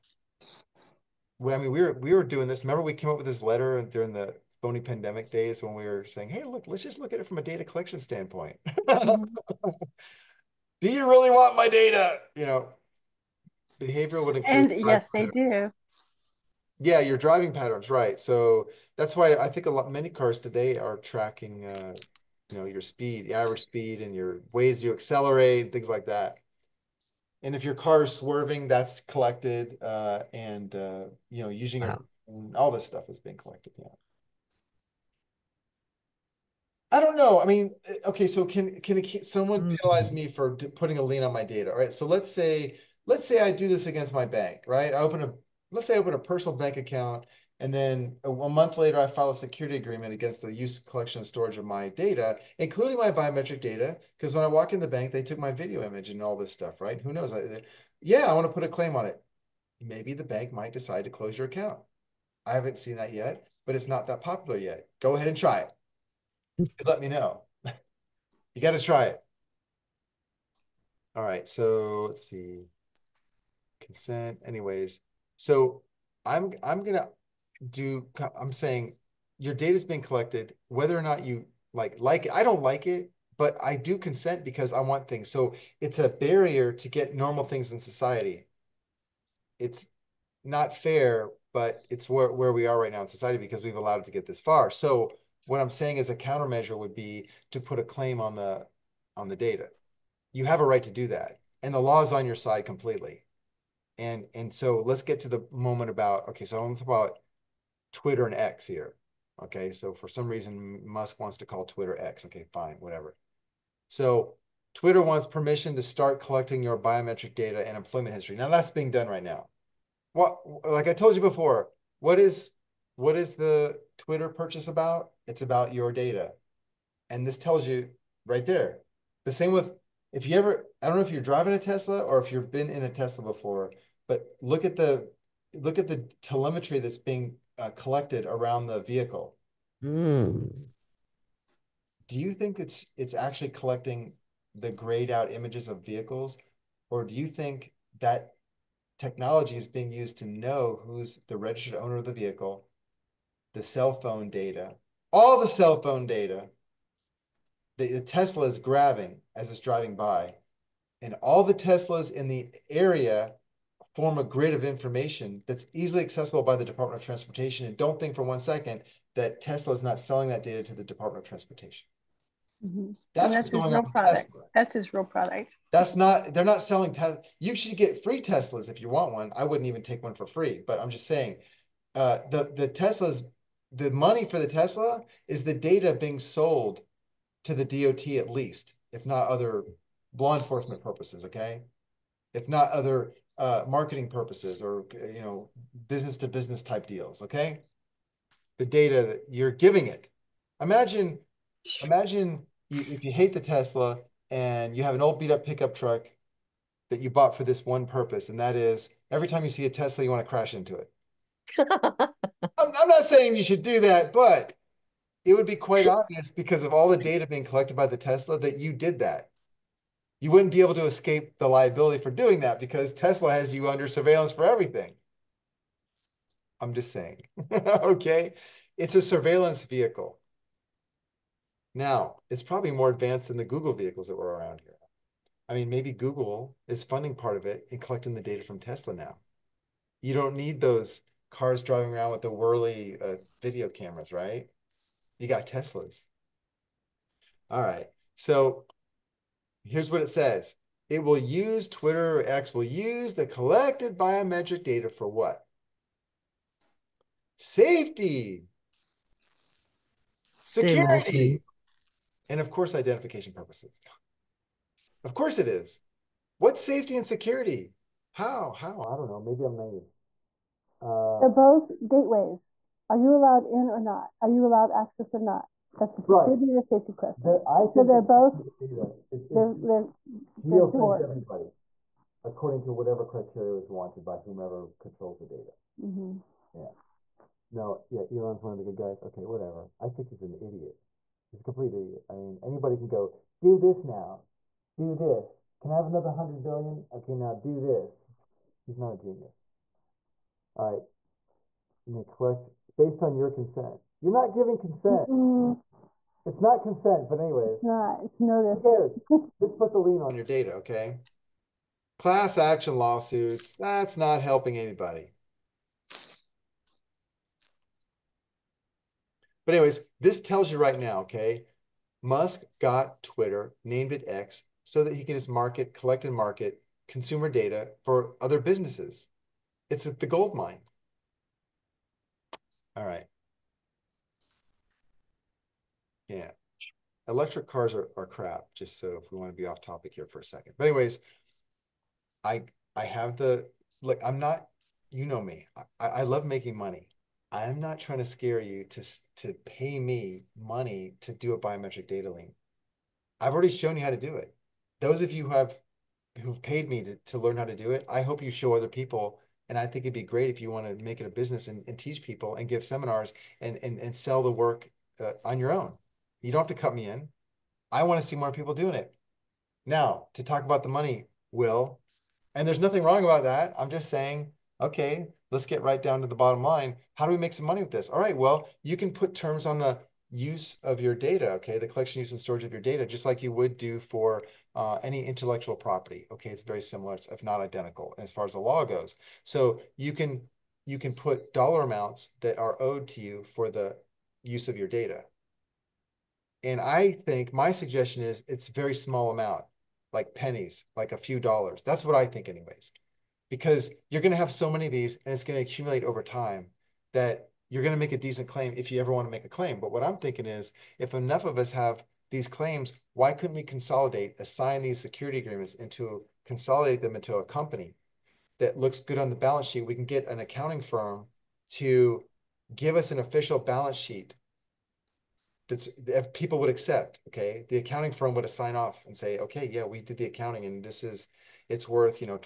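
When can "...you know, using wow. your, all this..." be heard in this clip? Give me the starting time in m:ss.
0:31.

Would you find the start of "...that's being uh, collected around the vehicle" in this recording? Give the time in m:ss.
2:16.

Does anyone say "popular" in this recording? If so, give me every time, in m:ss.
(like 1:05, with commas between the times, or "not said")
1:04.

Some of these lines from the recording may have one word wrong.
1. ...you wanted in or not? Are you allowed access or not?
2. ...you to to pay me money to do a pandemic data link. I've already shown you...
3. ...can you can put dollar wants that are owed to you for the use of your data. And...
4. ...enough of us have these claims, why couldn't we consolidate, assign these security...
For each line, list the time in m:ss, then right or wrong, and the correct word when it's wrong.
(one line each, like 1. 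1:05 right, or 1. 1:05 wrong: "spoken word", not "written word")
1. 4:32 wrong: "allowed", not "wanted"
2. 5:48 wrong: "biometric", not "pandemic"
3. 6:29 wrong: "amounts", not "wants"
4. 6:50 right.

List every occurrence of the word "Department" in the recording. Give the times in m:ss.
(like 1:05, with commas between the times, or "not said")
2:46, 2:50.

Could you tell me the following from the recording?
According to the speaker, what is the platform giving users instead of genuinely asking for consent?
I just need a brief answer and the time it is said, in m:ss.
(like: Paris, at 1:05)
Notice, at 5:08.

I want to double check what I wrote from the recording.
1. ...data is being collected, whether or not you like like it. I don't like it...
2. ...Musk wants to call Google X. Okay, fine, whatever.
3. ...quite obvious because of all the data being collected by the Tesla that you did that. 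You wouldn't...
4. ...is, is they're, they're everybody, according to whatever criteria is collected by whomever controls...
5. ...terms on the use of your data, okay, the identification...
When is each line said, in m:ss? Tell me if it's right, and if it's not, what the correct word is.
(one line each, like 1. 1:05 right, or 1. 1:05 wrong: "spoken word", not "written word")
1. 1:19 right
2. 1:50 wrong: "Twitter", not "Google"
3. 3:35 right
4. 4:39 wrong: "wanted", not "collected"
5. 6:19 wrong: "collection", not "identification".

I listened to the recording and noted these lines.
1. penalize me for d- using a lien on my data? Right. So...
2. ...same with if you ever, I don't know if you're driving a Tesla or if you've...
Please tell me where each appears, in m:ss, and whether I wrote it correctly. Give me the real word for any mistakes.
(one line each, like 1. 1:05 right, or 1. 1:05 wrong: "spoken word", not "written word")
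1. 0:39 wrong: "putting", not "using"
2. 2:09 right.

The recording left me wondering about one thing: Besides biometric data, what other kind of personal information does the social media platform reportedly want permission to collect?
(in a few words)
Employment history.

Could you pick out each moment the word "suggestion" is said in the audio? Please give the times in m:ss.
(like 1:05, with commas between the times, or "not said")
6:37.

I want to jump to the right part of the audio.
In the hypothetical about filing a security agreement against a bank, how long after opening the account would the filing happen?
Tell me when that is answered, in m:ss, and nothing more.
0:48.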